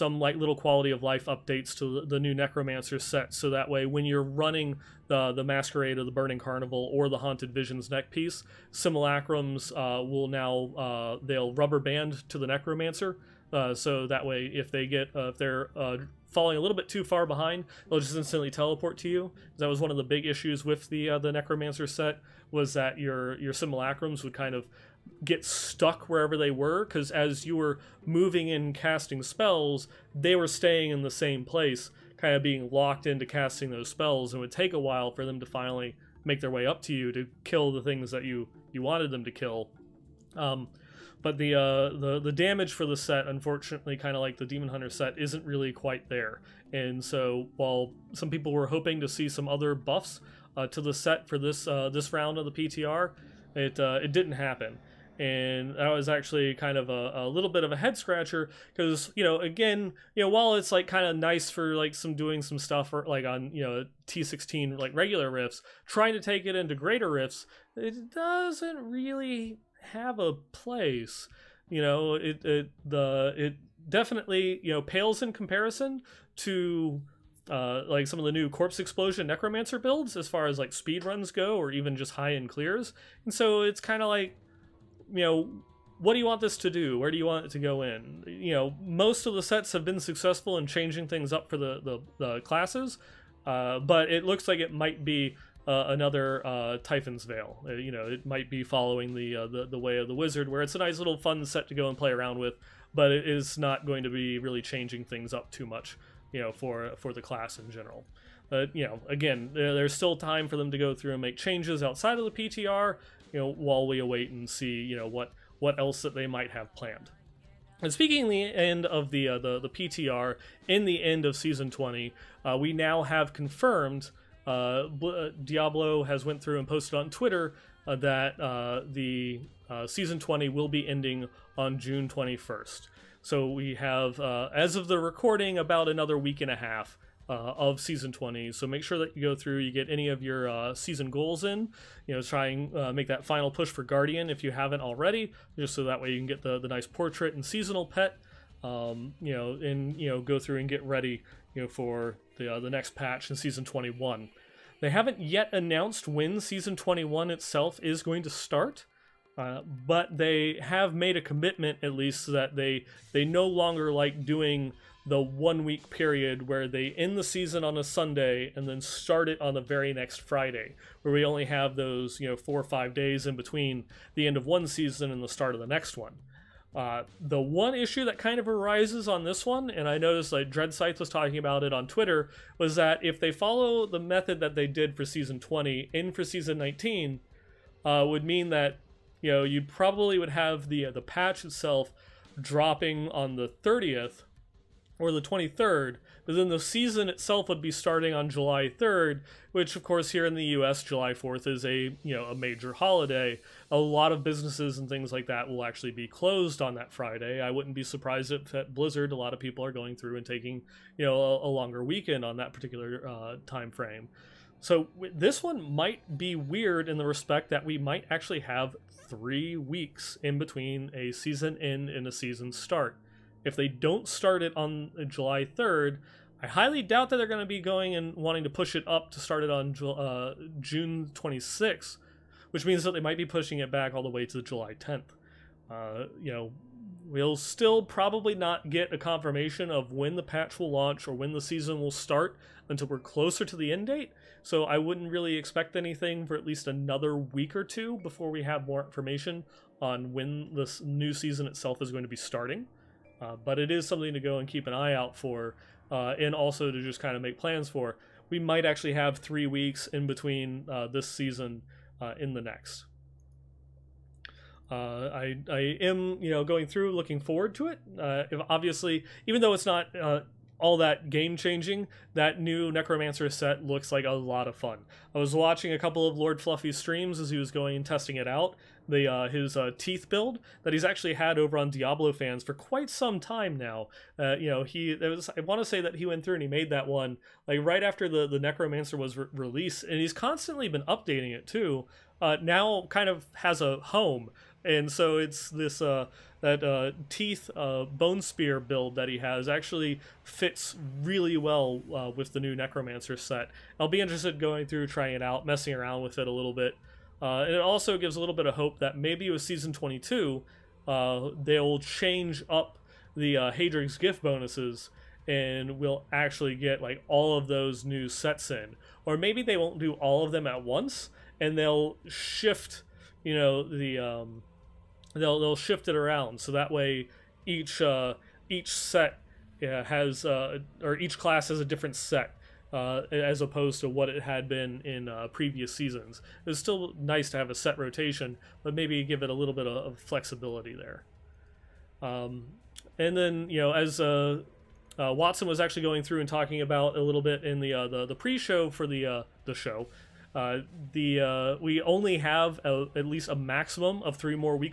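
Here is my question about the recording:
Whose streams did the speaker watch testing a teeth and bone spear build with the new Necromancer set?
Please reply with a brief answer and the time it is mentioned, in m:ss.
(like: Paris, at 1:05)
Lord Fluffy, at 4:36.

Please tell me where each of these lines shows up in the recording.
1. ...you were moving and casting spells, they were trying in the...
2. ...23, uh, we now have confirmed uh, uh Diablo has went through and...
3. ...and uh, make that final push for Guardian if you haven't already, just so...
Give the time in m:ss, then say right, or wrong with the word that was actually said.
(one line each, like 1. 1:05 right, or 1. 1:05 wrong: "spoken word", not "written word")
1. 0:27 wrong: "staying", not "trying"
2. 2:01 wrong: "20", not "23"
3. 2:22 right.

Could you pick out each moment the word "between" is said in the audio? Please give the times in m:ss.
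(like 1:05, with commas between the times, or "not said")
2:53, 3:40, 4:20.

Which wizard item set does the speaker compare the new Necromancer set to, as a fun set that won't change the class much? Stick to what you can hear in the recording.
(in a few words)
Typhon's Veil.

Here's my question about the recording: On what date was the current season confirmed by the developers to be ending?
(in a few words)
June 21st.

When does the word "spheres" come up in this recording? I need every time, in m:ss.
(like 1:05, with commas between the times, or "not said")
not said.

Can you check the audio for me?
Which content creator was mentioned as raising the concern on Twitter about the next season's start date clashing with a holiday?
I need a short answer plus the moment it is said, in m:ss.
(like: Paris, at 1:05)
Dread Sites, at 3:00.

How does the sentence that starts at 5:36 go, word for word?
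It's still nice to have a set rotation, but maybe give it a little bit of, flexibility there.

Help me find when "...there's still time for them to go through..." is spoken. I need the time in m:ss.
1:49.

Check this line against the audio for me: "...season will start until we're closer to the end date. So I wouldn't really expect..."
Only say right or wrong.
right.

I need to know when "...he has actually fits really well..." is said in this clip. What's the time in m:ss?
4:59.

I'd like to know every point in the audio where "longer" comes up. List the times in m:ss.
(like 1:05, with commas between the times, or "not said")
2:43, 3:31.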